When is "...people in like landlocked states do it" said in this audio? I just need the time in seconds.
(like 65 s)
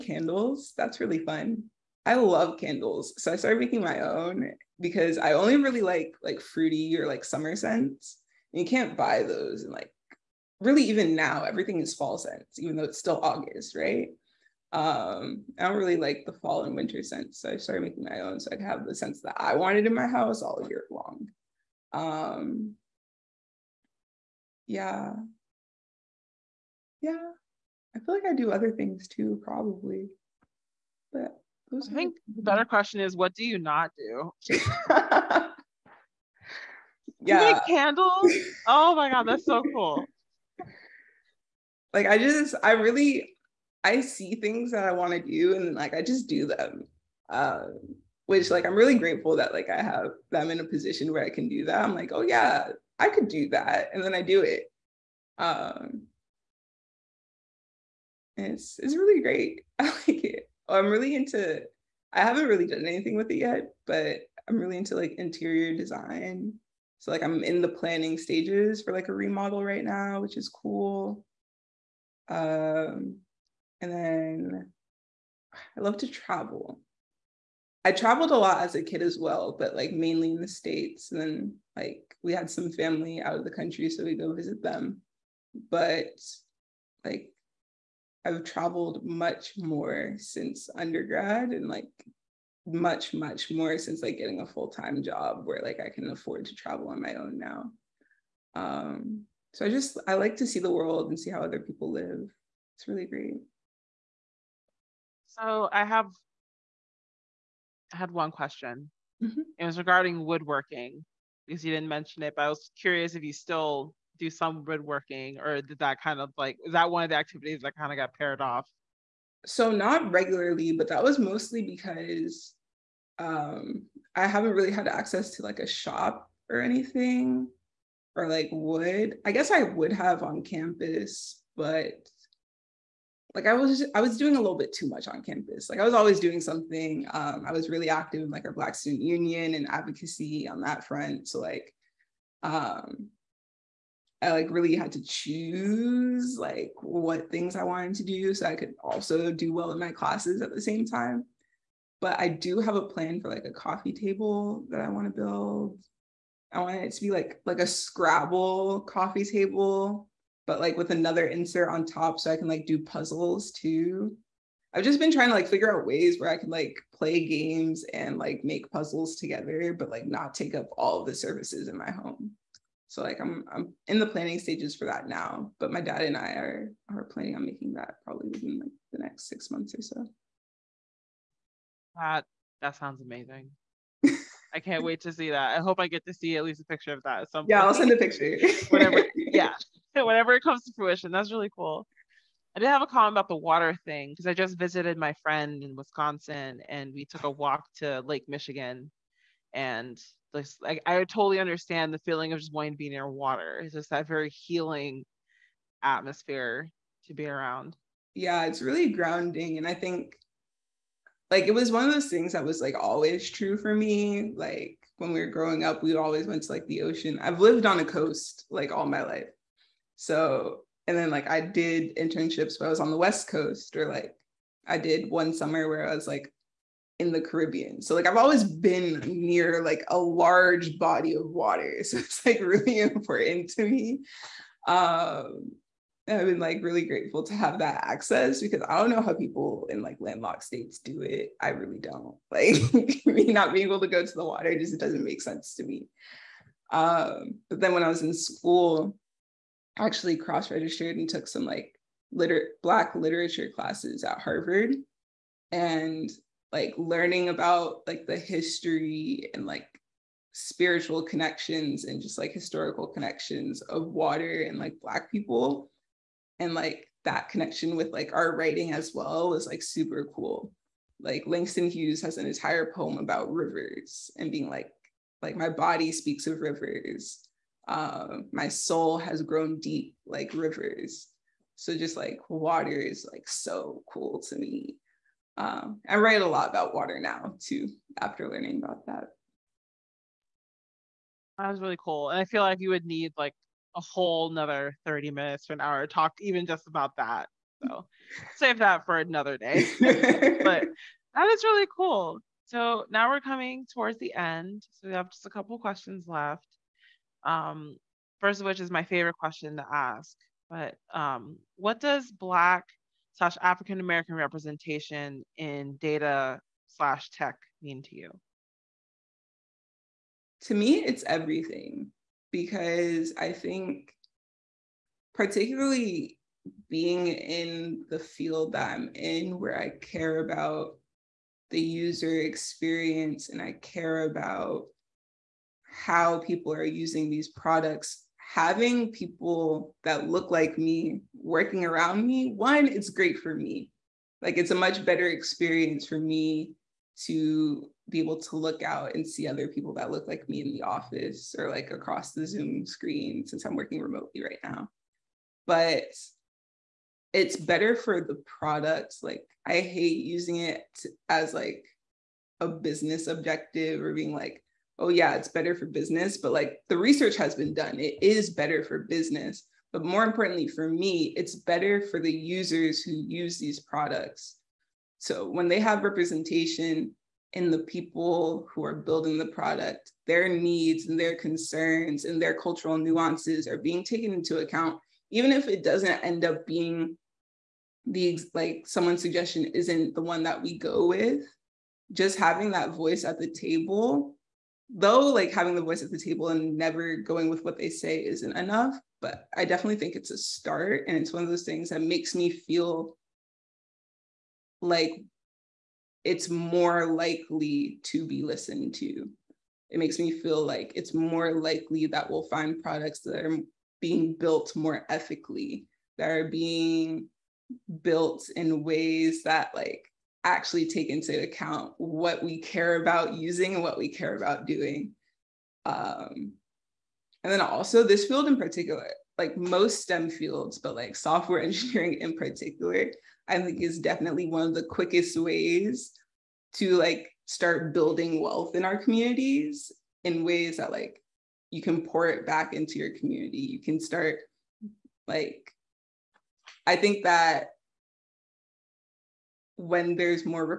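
239 s.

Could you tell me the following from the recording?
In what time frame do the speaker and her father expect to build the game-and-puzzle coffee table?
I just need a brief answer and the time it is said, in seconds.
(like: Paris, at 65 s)
six months, at 179 s.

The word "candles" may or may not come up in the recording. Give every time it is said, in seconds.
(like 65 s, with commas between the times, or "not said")
2 s, 37 s.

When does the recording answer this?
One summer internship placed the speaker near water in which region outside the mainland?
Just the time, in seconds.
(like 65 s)
227 s.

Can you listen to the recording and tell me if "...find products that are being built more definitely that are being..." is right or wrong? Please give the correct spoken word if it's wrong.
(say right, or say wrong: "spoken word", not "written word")
wrong: "ethically", not "definitely".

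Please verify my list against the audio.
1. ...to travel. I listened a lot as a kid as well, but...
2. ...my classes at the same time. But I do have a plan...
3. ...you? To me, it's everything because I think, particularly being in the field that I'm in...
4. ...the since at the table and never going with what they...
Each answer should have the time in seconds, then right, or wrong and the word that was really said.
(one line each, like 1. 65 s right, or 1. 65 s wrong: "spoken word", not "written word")
1. 75 s wrong: "traveled", not "listened"
2. 149 s right
3. 317 s right
4. 395 s wrong: "voice", not "since".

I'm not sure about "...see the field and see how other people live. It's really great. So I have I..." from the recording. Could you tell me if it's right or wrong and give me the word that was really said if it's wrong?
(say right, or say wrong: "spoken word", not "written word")
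wrong: "world", not "field".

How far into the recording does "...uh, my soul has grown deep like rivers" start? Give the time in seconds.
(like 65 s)
277 s.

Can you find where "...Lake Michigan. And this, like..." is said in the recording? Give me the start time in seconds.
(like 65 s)
198 s.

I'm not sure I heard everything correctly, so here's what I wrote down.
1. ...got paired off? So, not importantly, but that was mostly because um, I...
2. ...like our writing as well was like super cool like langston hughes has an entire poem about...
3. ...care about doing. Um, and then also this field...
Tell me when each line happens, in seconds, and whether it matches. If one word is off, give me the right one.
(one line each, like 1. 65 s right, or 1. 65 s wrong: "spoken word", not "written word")
1. 117 s wrong: "regularly", not "importantly"
2. 267 s right
3. 423 s right.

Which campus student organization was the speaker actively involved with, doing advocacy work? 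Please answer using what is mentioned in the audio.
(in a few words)
Black Student Union.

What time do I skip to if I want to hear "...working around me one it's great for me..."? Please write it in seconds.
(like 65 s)
341 s.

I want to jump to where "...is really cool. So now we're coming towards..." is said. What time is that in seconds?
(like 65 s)
301 s.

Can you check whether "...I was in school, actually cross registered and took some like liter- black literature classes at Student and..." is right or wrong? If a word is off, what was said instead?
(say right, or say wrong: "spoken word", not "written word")
wrong: "Harvard", not "Student".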